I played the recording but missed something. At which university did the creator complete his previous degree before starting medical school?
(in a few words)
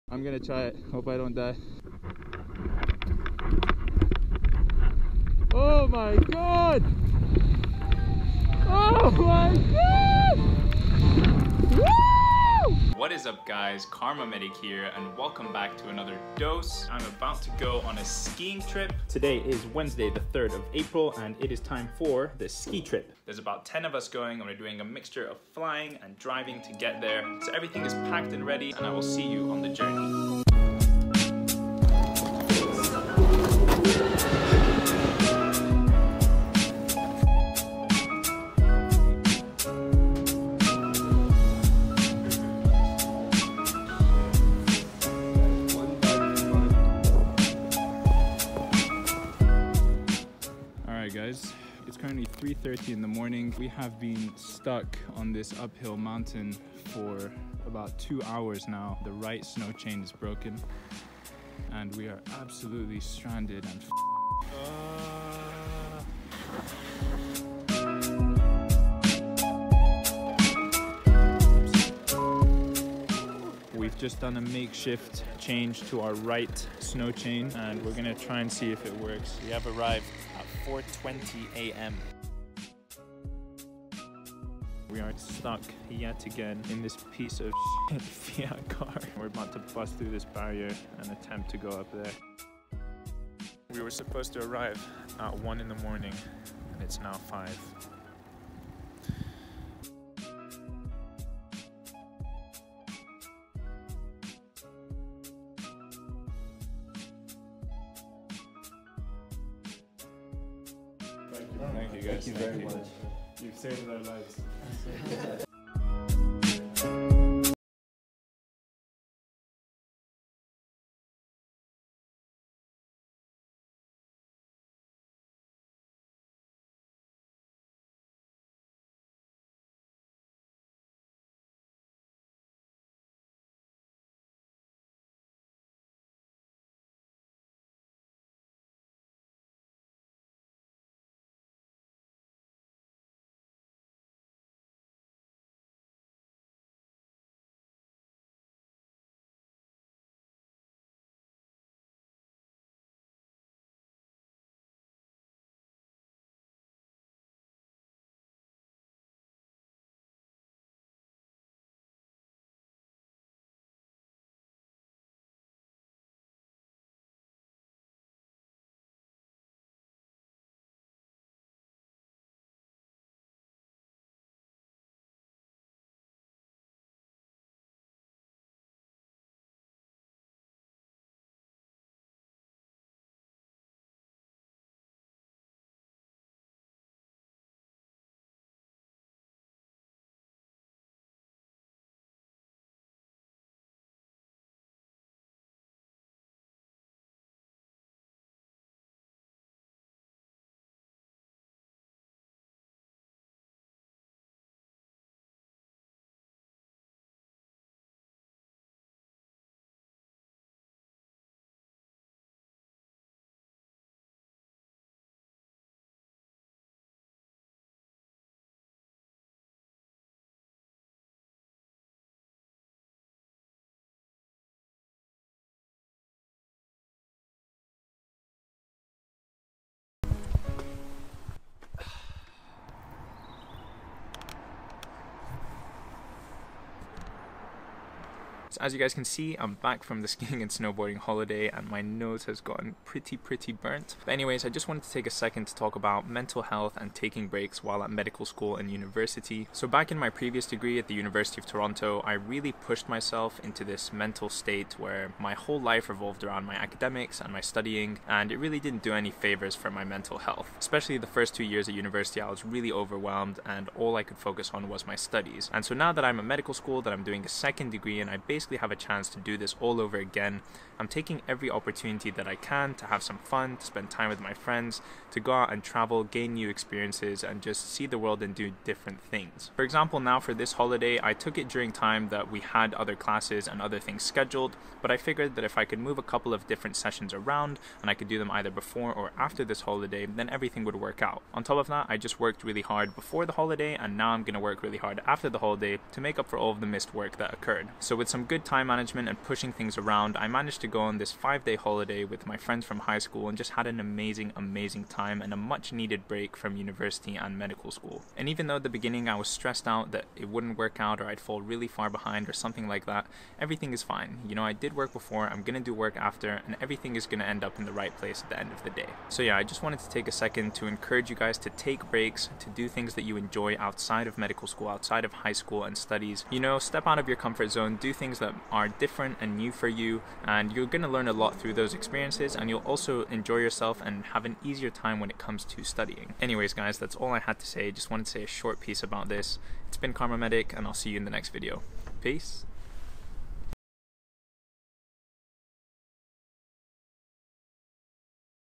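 University of Toronto.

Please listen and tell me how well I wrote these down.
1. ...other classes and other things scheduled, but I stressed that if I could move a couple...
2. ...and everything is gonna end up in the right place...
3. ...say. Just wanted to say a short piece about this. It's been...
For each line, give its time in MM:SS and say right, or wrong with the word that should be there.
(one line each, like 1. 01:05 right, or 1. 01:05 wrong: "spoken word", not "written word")
1. 04:42 wrong: "figured", not "stressed"
2. 05:16 right
3. 05:37 right.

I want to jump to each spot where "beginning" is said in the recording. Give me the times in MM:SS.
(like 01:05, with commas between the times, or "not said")
05:08.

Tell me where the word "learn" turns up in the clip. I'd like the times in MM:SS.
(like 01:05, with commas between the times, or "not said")
05:30.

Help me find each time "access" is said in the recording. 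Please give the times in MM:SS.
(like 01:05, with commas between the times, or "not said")
not said.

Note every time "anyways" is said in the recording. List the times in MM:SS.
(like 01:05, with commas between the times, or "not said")
04:04, 05:36.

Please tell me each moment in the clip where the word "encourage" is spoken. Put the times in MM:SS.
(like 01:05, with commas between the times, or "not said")
05:20.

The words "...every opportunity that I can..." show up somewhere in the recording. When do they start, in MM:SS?
04:31.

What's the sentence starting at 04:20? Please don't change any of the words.
Especially the first two years at university, I was really overwhelmed and all I could focus on was my studies.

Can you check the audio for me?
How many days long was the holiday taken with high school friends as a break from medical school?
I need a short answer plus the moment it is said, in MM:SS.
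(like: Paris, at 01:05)
five day, at 05:01.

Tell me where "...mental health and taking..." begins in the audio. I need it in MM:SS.
04:06.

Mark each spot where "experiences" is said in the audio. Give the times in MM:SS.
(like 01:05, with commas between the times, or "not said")
04:36, 05:31.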